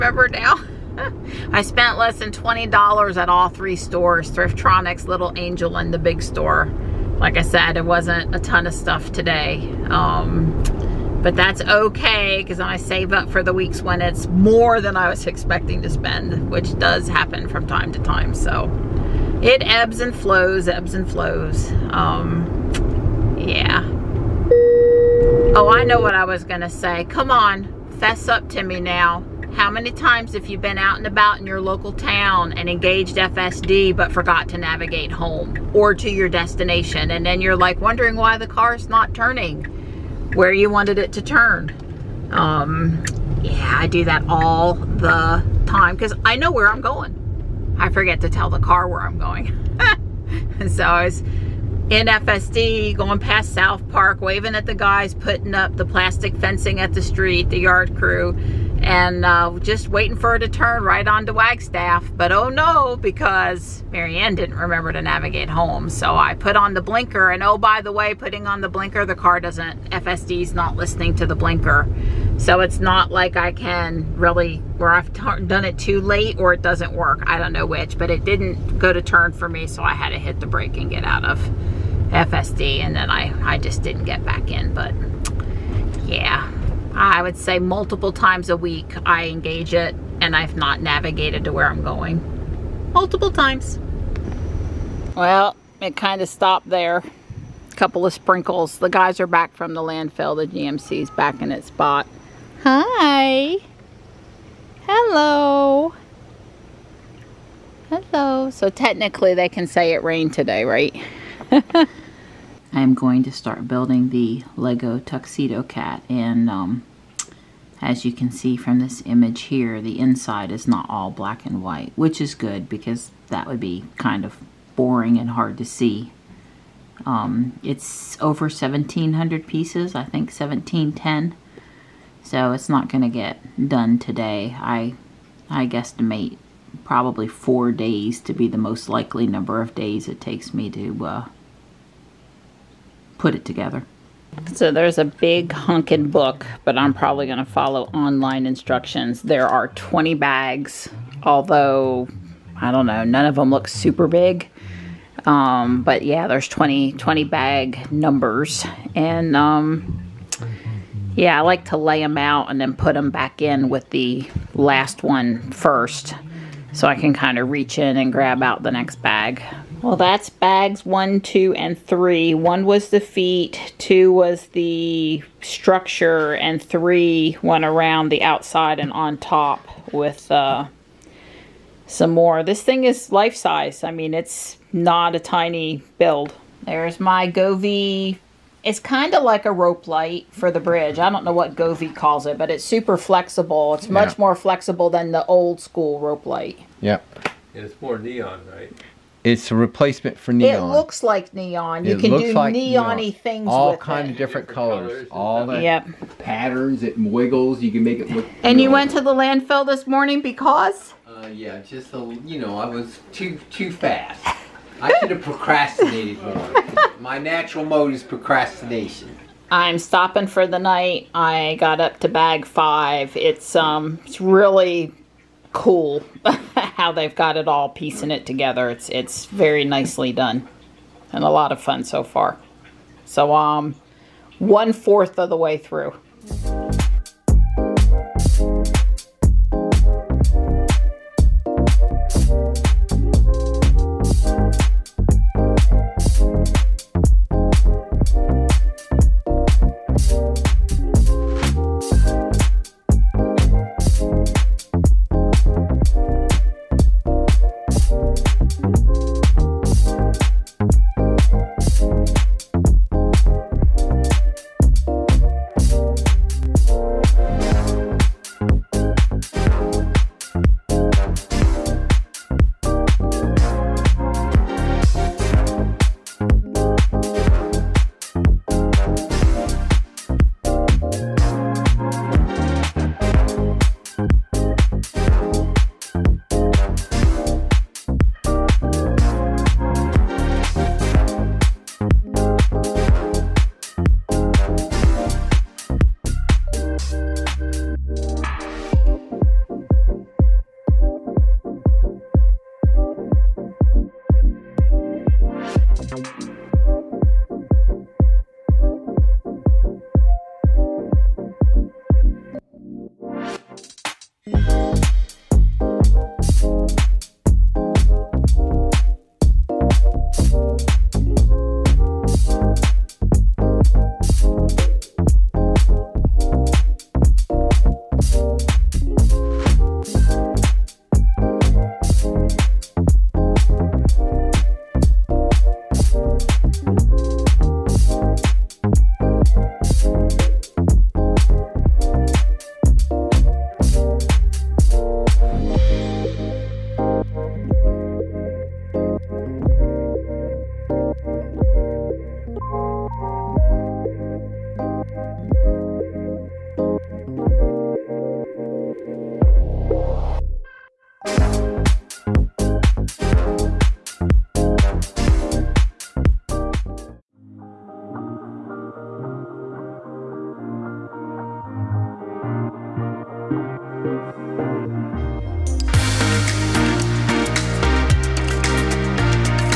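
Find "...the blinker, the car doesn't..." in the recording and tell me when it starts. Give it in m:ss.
1:08.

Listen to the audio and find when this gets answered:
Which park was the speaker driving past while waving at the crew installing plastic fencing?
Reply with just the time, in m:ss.
0:53.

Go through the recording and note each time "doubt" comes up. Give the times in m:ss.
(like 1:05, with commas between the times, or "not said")
not said.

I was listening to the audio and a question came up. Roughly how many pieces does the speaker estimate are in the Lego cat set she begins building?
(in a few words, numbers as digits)
1710.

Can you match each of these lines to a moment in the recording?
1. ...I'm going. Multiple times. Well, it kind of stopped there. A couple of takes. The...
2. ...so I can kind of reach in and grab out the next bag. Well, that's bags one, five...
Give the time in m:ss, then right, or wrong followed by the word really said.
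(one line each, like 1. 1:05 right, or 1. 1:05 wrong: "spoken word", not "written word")
1. 1:31 wrong: "sprinkles", not "takes"
2. 2:46 wrong: "two", not "five".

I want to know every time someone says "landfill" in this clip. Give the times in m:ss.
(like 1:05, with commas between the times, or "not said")
1:39, 3:29.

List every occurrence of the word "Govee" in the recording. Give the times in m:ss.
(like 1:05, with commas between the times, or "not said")
3:07, 3:11.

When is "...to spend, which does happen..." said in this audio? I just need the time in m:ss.
0:15.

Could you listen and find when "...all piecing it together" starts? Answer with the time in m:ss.
3:47.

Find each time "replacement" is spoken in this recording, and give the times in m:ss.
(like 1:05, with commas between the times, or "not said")
3:19.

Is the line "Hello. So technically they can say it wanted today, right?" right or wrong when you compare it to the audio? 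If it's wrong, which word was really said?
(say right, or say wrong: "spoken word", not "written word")
wrong: "rained", not "wanted".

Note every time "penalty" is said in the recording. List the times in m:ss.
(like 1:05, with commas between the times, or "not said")
not said.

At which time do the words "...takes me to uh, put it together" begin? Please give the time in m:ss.
2:20.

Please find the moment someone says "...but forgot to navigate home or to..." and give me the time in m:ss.
0:33.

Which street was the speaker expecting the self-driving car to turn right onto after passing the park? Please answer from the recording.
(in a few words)
Wagstaff.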